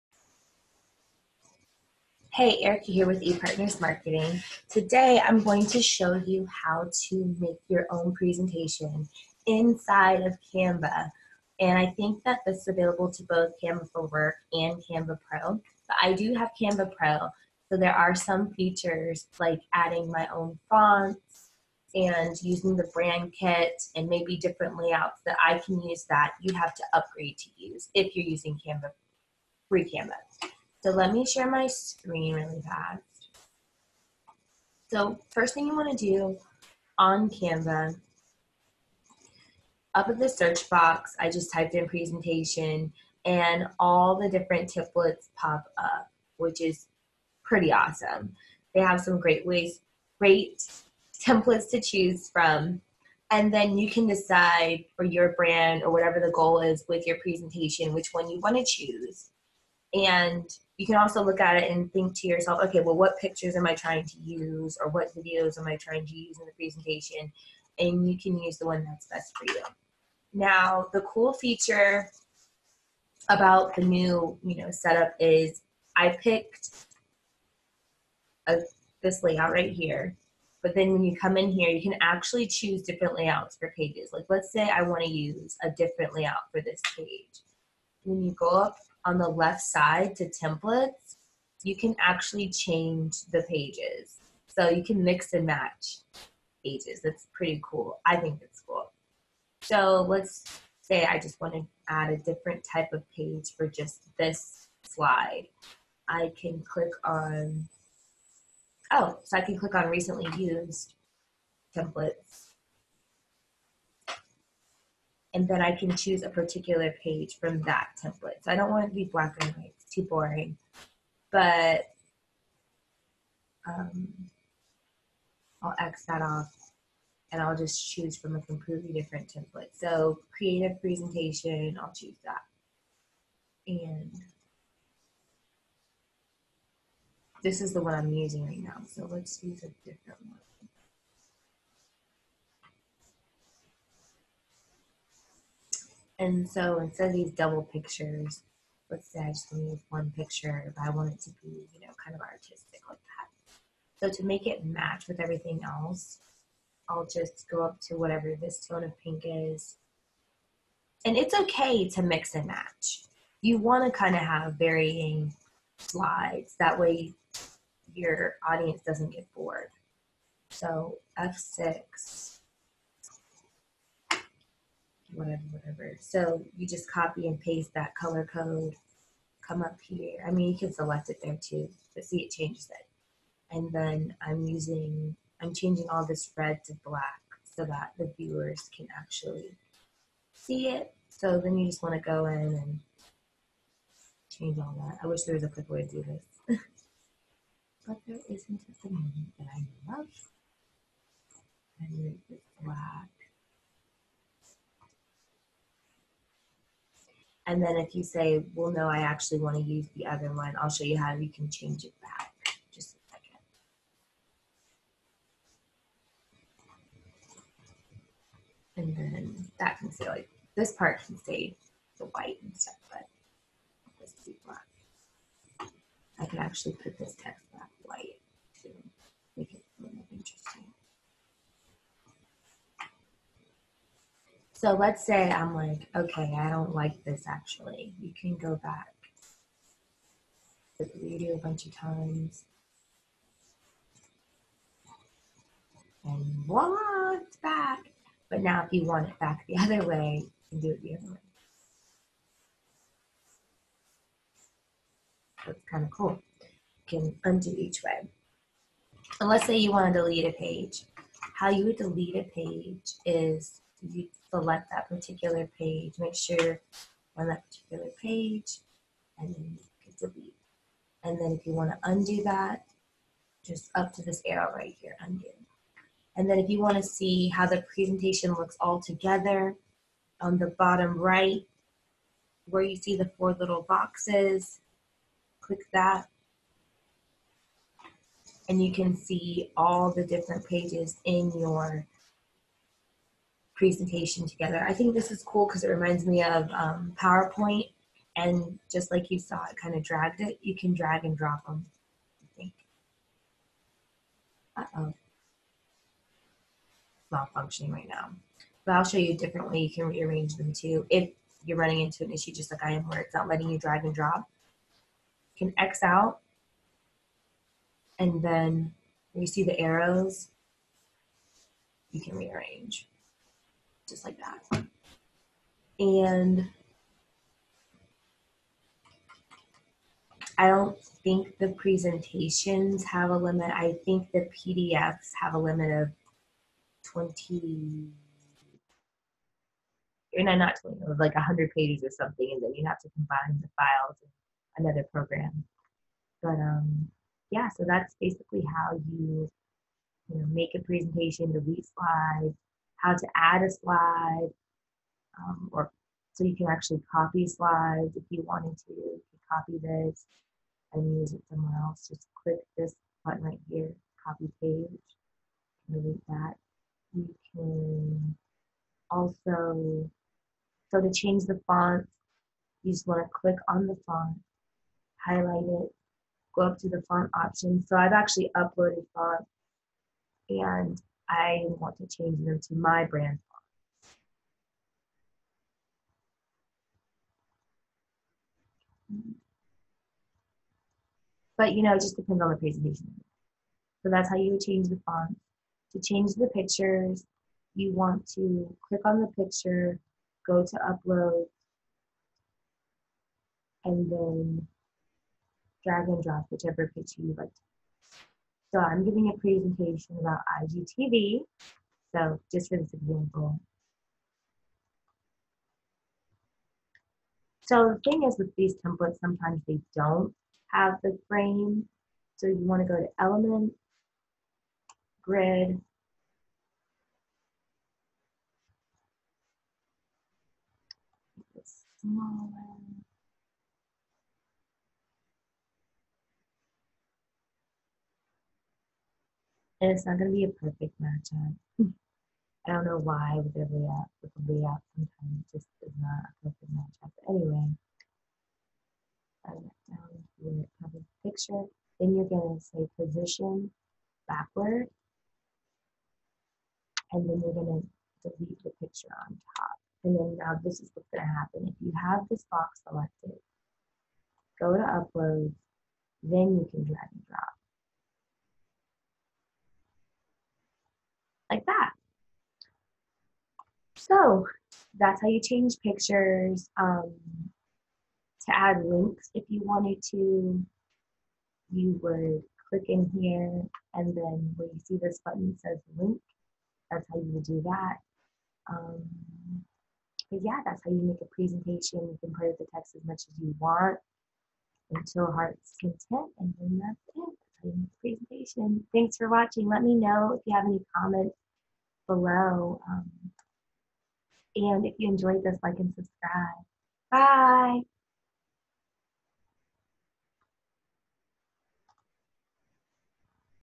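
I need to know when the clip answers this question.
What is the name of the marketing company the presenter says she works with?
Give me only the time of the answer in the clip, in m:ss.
0:03.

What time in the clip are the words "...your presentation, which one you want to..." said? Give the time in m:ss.
0:57.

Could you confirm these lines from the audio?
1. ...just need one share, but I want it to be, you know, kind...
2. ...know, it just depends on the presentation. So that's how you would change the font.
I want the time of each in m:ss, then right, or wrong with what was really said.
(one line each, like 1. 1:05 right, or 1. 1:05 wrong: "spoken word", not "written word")
1. 2:29 wrong: "picture", not "share"
2. 6:31 right.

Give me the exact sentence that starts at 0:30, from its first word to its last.
So let me share my screen really fast.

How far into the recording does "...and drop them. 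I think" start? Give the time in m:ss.
5:01.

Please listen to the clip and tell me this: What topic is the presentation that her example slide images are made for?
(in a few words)
IGTV.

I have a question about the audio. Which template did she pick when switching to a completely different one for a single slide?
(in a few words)
creative presentation.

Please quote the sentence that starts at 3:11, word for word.
So then you just want to go in and change all that.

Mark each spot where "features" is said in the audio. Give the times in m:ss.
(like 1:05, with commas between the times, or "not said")
0:18, 1:11.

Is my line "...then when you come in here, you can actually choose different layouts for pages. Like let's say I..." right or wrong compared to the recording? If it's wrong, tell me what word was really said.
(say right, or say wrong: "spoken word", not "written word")
right.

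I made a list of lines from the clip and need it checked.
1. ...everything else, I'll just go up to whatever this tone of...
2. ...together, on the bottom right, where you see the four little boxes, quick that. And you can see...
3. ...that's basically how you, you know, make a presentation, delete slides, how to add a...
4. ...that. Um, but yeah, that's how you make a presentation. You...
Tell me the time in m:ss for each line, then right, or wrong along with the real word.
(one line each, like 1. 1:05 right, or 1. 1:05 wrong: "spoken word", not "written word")
1. 2:35 right
2. 4:38 wrong: "click", not "quick"
3. 5:47 right
4. 8:07 right.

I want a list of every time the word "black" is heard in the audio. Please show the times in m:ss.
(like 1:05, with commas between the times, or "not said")
1:59, 3:06, 3:22, 3:44.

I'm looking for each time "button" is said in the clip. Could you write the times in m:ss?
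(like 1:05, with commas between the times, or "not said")
6:03, 8:05.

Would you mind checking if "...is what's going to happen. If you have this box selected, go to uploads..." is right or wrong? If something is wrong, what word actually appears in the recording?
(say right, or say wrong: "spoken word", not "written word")
right.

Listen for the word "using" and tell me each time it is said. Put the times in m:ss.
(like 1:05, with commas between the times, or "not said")
0:22, 0:28, 2:18, 3:04.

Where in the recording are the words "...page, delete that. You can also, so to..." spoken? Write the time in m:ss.
6:04.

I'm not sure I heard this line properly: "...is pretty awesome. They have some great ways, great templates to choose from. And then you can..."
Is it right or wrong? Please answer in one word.
right.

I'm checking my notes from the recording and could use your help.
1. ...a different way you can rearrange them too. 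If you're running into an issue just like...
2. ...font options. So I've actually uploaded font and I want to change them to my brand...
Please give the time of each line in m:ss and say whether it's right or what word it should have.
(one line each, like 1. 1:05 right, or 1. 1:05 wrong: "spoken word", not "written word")
1. 5:09 right
2. 6:16 right.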